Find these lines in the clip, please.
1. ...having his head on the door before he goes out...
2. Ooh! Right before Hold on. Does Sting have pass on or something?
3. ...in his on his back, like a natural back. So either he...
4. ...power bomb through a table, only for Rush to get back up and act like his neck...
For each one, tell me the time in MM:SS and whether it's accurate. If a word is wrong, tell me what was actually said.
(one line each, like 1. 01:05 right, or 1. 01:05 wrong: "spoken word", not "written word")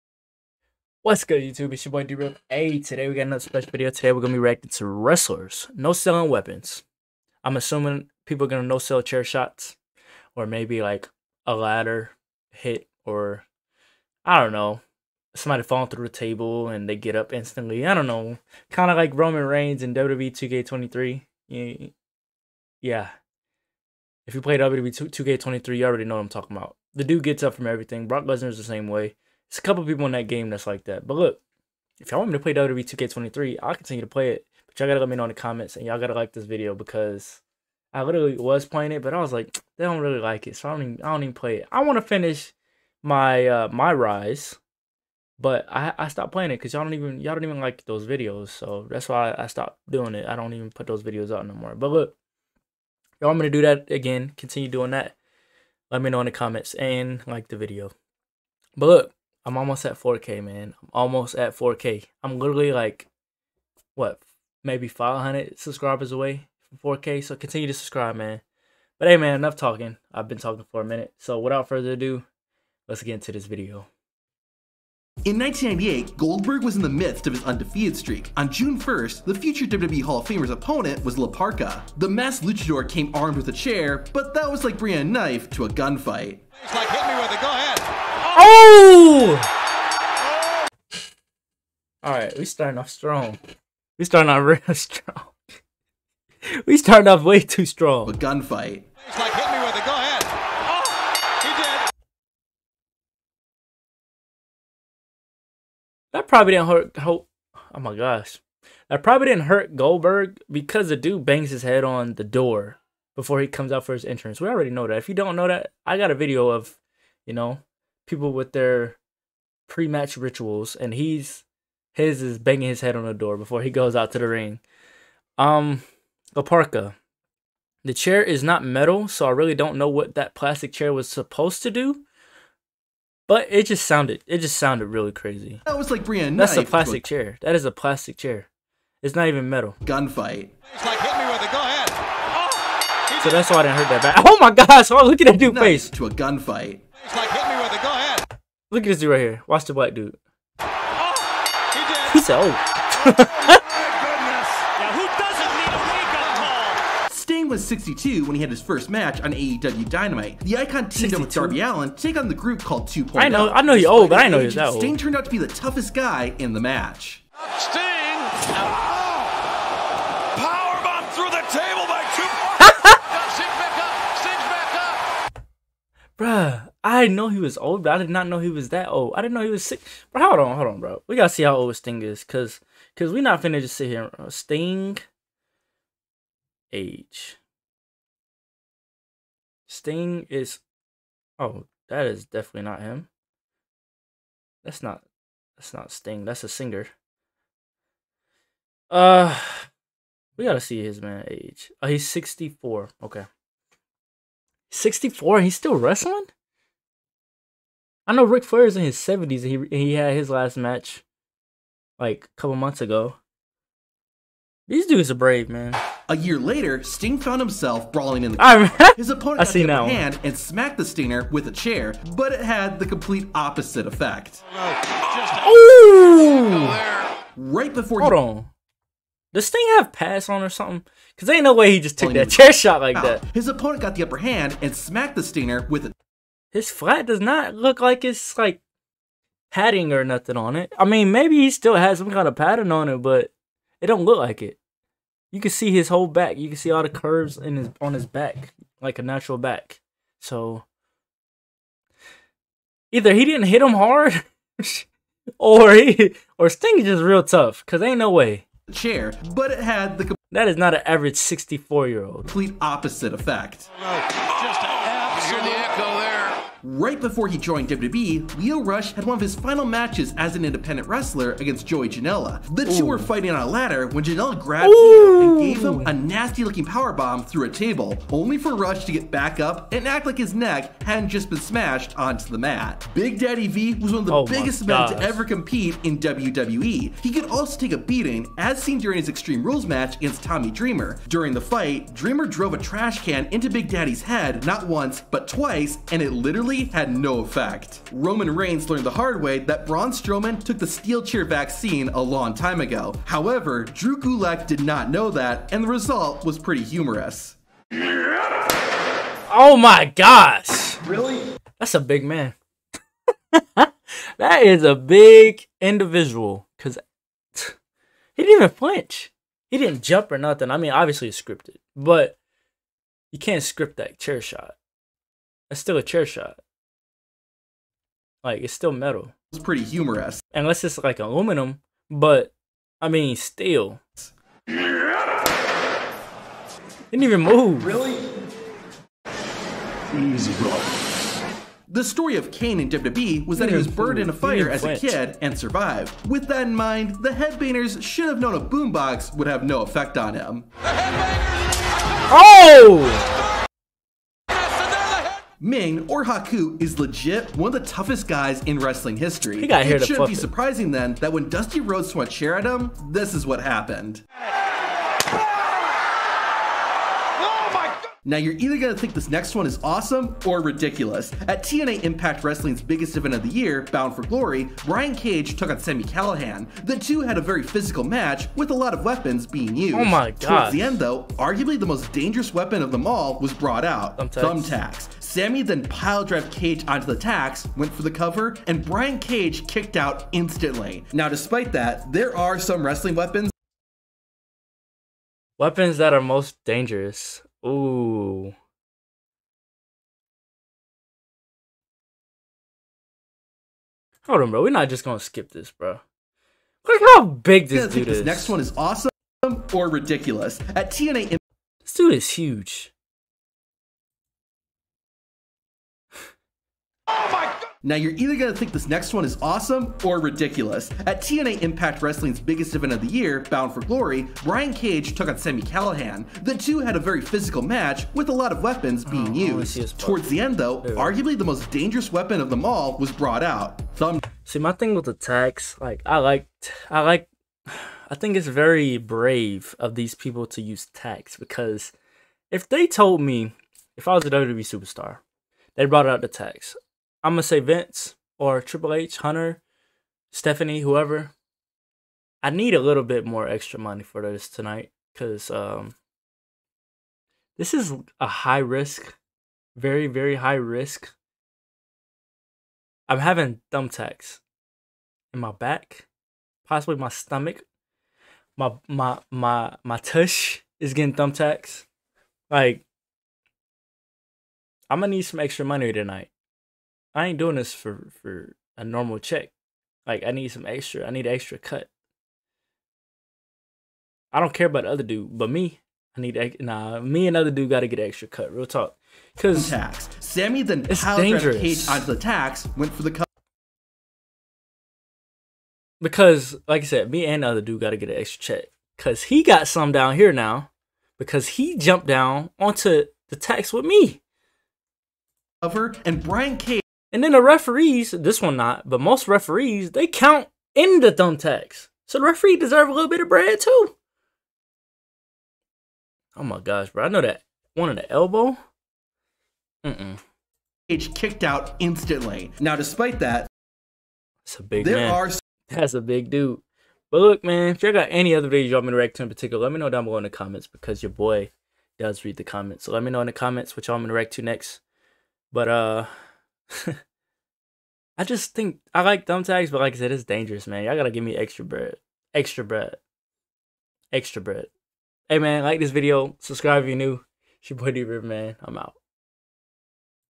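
1. 02:02 wrong: "banging", not "having"
2. 03:45 right
3. 04:07 right
4. 04:36 right.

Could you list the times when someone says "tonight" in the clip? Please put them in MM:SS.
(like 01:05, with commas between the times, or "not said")
07:34, 07:55.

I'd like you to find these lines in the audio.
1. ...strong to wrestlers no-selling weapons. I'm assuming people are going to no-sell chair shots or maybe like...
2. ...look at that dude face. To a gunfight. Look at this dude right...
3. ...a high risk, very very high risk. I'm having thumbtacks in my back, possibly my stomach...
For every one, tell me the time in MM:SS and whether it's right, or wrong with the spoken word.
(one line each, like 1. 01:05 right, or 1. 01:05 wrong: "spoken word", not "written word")
1. 00:04 wrong: "reacting", not "strong"
2. 02:25 right
3. 07:37 right.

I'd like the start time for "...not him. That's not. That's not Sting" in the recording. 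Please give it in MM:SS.
03:12.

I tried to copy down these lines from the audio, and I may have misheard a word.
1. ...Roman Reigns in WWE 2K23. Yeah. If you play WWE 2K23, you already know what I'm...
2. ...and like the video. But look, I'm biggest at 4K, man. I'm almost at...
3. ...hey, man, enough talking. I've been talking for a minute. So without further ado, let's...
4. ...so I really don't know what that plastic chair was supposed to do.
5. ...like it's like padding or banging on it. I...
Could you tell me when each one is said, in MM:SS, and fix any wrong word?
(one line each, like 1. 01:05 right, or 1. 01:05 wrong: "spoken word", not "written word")
1. 00:19 right
2. 00:56 wrong: "almost", not "biggest"
3. 01:09 right
4. 02:09 right
5. 03:57 wrong: "nothing", not "banging".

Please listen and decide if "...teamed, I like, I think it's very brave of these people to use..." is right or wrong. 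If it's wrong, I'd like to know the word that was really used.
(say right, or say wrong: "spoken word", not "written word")
wrong: "liked", not "teamed".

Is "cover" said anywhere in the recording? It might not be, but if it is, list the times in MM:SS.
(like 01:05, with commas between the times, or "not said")
06:27, 08:25.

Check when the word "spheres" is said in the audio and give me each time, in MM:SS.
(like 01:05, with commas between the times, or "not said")
not said.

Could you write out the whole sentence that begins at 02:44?
Sting turned out to be the toughest guy in the match.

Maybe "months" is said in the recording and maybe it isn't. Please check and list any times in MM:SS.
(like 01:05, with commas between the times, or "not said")
03:32.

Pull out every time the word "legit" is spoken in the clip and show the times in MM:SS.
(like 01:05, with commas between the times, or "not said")
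05:56.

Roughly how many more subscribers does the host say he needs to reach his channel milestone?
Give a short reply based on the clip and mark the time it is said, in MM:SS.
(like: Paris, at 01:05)
500, at 01:04.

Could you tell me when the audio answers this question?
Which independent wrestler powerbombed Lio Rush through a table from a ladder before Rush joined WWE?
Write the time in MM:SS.
04:31.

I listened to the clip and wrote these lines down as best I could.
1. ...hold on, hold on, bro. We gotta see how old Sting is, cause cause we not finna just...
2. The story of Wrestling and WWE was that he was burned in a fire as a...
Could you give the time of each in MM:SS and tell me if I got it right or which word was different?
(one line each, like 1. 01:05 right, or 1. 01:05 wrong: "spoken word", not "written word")
1. 03:00 right
2. 05:41 wrong: "Kane", not "Wrestling".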